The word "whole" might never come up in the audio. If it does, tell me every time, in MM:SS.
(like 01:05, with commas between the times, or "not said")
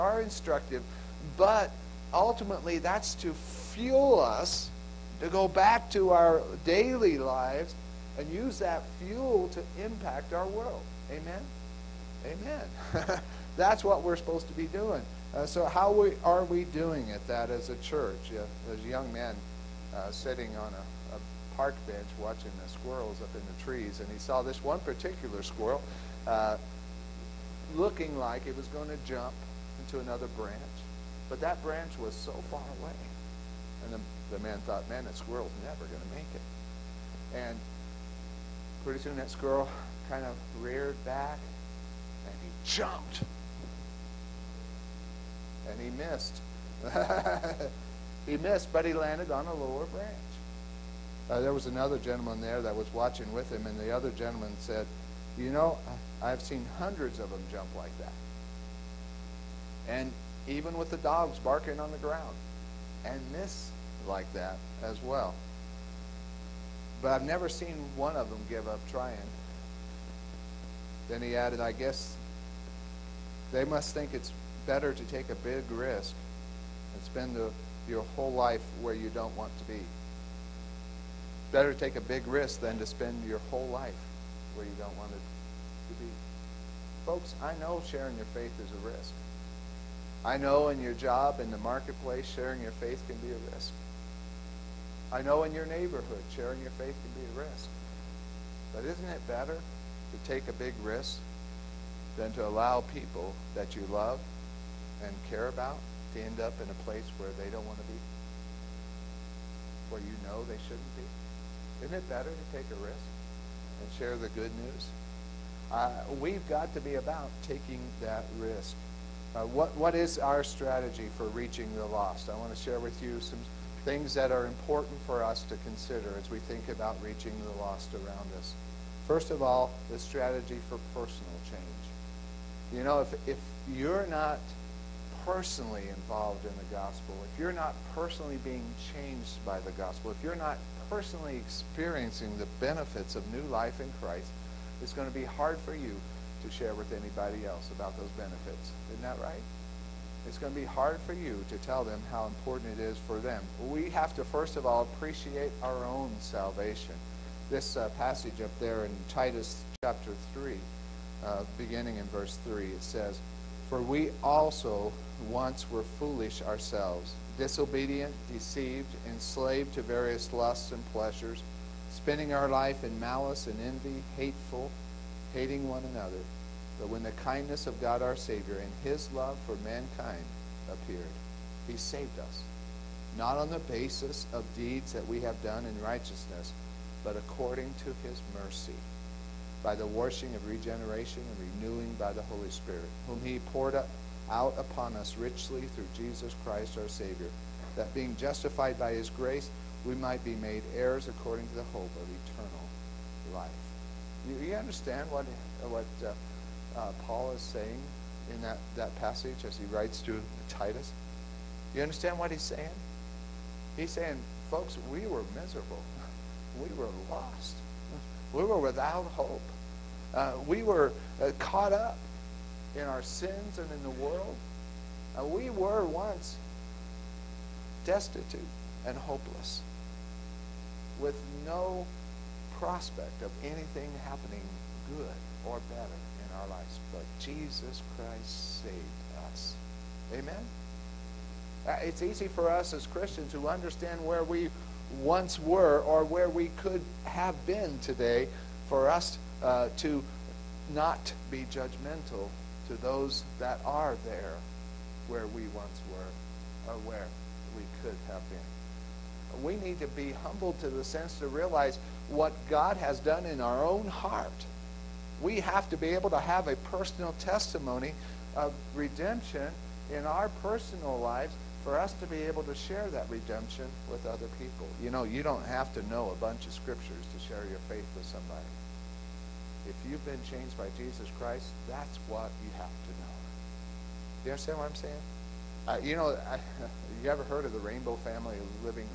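01:18, 01:23.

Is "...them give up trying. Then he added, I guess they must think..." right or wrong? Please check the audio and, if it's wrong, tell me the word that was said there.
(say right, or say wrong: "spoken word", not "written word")
right.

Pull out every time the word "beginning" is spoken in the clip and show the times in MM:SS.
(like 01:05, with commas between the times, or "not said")
02:41.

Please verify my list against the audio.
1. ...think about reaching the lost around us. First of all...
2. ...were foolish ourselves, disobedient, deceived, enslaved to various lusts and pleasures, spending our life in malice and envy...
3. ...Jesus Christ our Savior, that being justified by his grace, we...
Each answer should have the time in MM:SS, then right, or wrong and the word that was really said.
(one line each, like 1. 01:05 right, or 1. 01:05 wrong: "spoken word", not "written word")
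1. 02:06 right
2. 02:45 right
3. 03:15 right.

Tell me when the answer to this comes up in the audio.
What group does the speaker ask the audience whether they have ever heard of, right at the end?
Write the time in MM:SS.
04:47.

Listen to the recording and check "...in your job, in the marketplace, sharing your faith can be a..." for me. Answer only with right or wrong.
right.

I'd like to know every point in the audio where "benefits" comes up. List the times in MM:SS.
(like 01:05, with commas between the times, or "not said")
02:22, 02:28.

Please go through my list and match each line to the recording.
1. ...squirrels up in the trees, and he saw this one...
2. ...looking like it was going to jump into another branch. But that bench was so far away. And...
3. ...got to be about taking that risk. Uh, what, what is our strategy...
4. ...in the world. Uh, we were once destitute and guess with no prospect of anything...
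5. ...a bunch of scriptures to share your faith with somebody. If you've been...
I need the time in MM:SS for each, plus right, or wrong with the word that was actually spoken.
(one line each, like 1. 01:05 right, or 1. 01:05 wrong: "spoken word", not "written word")
1. 00:22 right
2. 00:27 wrong: "branch", not "bench"
3. 01:56 right
4. 03:43 wrong: "hopeless", not "guess"
5. 04:36 right.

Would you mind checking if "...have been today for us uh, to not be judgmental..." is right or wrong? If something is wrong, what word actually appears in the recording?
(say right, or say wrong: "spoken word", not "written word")
right.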